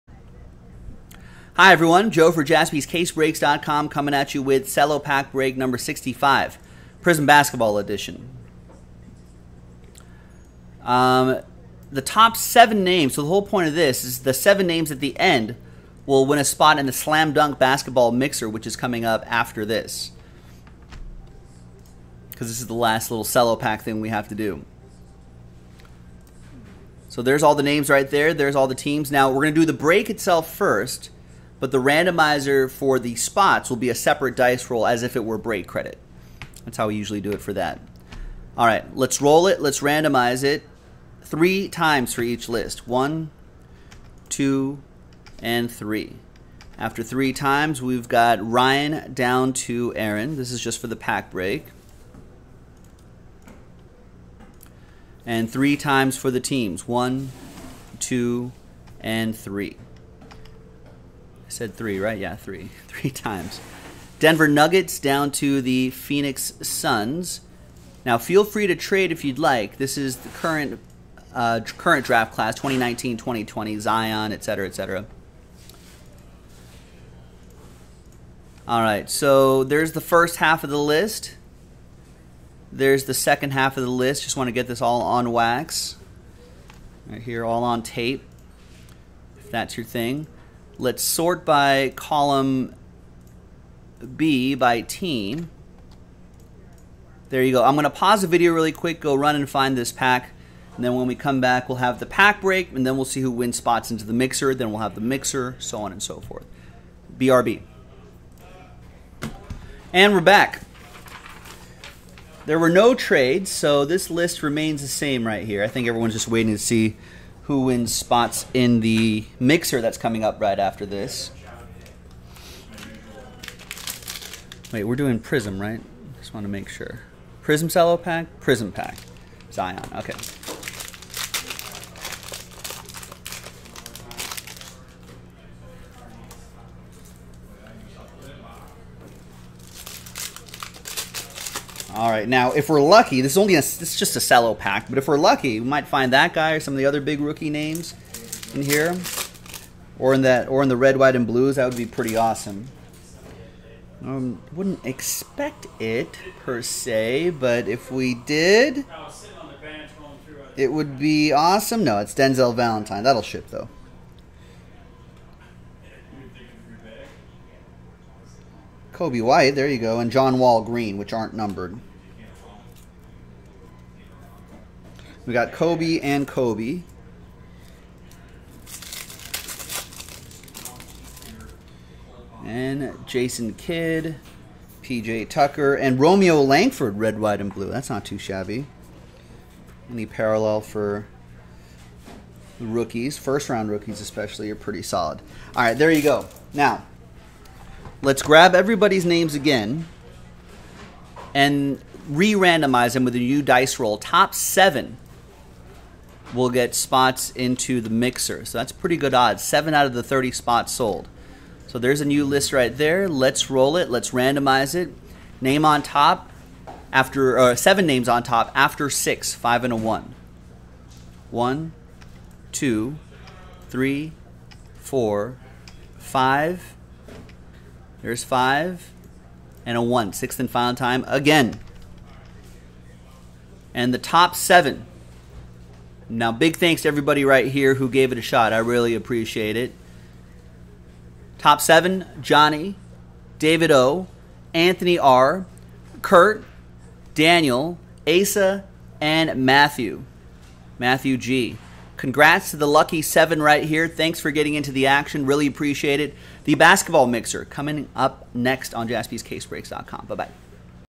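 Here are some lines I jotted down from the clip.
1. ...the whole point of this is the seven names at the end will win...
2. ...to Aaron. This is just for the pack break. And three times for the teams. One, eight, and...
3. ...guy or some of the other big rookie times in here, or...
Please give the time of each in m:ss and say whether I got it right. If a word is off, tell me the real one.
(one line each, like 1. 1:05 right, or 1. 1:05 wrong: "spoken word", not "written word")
1. 0:13 right
2. 0:49 wrong: "two", not "eight"
3. 2:26 wrong: "names", not "times".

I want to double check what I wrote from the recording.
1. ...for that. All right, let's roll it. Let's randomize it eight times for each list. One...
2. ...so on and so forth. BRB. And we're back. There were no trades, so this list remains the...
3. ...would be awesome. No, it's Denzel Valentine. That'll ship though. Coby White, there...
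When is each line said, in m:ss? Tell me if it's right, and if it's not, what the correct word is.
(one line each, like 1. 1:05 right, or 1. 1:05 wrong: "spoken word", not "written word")
1. 0:37 wrong: "three", not "eight"
2. 1:45 right
3. 2:40 right.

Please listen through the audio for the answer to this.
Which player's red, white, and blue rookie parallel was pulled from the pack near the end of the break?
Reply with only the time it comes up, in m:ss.
3:05.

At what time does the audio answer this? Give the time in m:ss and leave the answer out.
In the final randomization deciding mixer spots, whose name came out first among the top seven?
4:02.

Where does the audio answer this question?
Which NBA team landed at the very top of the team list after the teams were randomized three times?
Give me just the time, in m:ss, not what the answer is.
1:04.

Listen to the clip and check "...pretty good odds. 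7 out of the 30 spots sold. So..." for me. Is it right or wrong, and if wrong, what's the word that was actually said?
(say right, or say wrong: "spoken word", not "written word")
right.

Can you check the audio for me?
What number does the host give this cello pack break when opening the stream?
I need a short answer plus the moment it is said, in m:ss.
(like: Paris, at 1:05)
65, at 0:05.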